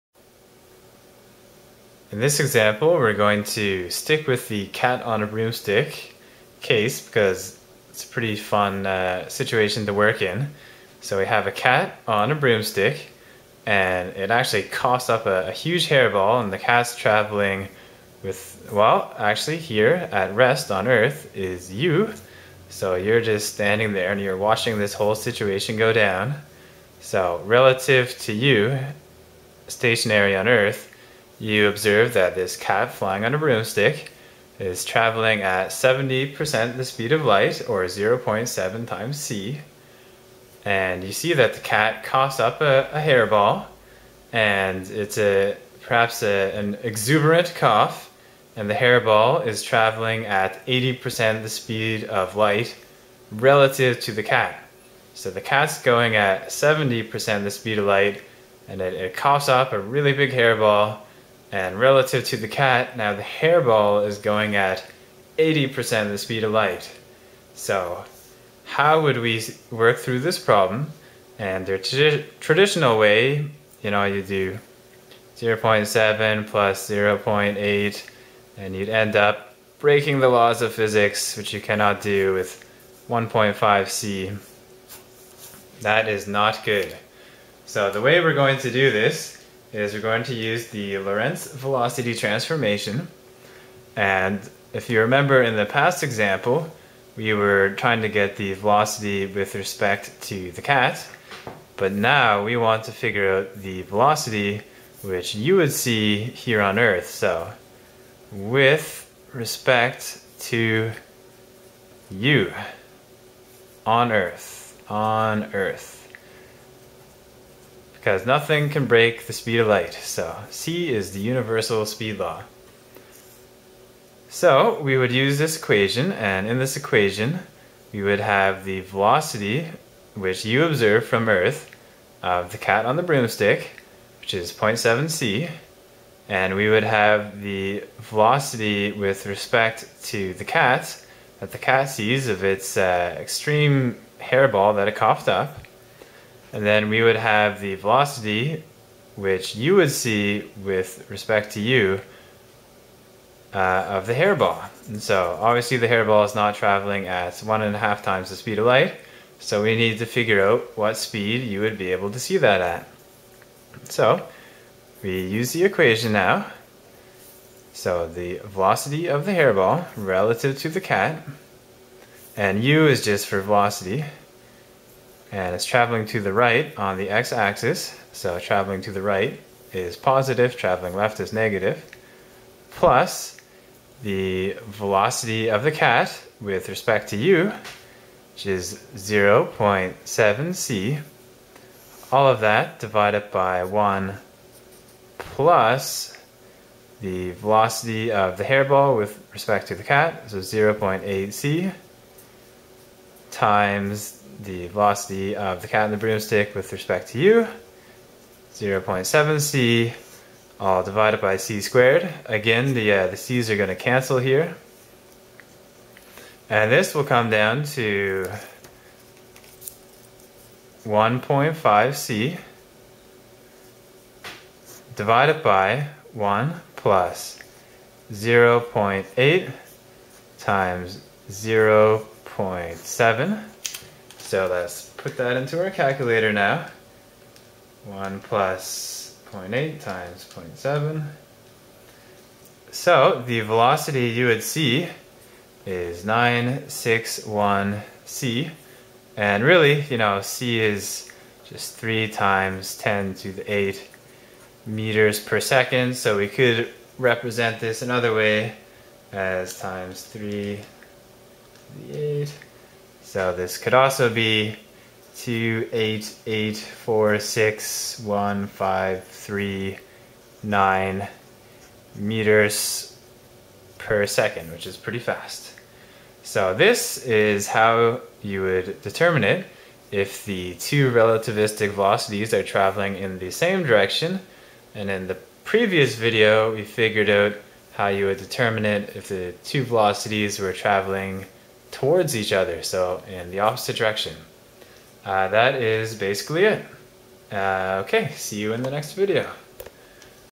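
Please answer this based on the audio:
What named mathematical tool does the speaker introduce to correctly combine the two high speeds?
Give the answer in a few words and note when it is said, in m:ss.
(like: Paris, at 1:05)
Lorentz velocity transformation, at 1:30.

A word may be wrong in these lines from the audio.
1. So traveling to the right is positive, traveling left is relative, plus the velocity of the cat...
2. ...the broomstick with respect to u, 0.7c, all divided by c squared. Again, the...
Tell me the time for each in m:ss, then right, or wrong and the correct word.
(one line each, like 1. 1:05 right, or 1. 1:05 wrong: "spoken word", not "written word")
1. 2:58 wrong: "negative", not "relative"
2. 3:25 right.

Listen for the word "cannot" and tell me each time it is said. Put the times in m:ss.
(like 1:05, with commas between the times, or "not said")
1:21.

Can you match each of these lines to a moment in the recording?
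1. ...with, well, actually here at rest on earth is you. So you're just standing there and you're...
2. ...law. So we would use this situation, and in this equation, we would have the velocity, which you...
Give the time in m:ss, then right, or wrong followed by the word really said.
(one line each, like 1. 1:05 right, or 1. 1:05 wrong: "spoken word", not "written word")
1. 0:18 right
2. 2:02 wrong: "equation", not "situation".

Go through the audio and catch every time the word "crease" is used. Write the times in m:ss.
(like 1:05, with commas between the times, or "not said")
not said.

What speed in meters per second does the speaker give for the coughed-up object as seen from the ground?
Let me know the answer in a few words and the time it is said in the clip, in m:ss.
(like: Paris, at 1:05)
288,461,539 m/s, at 4:25.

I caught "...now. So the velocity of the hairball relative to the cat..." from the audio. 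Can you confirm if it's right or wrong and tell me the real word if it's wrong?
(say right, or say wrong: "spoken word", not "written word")
right.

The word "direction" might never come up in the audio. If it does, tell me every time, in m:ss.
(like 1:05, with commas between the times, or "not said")
4:43, 4:53.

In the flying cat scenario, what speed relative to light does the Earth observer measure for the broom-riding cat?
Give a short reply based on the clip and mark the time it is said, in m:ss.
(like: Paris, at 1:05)
0.7c, at 0:37.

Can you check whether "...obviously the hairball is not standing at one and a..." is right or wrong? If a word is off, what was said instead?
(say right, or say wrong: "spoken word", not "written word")
wrong: "traveling", not "standing".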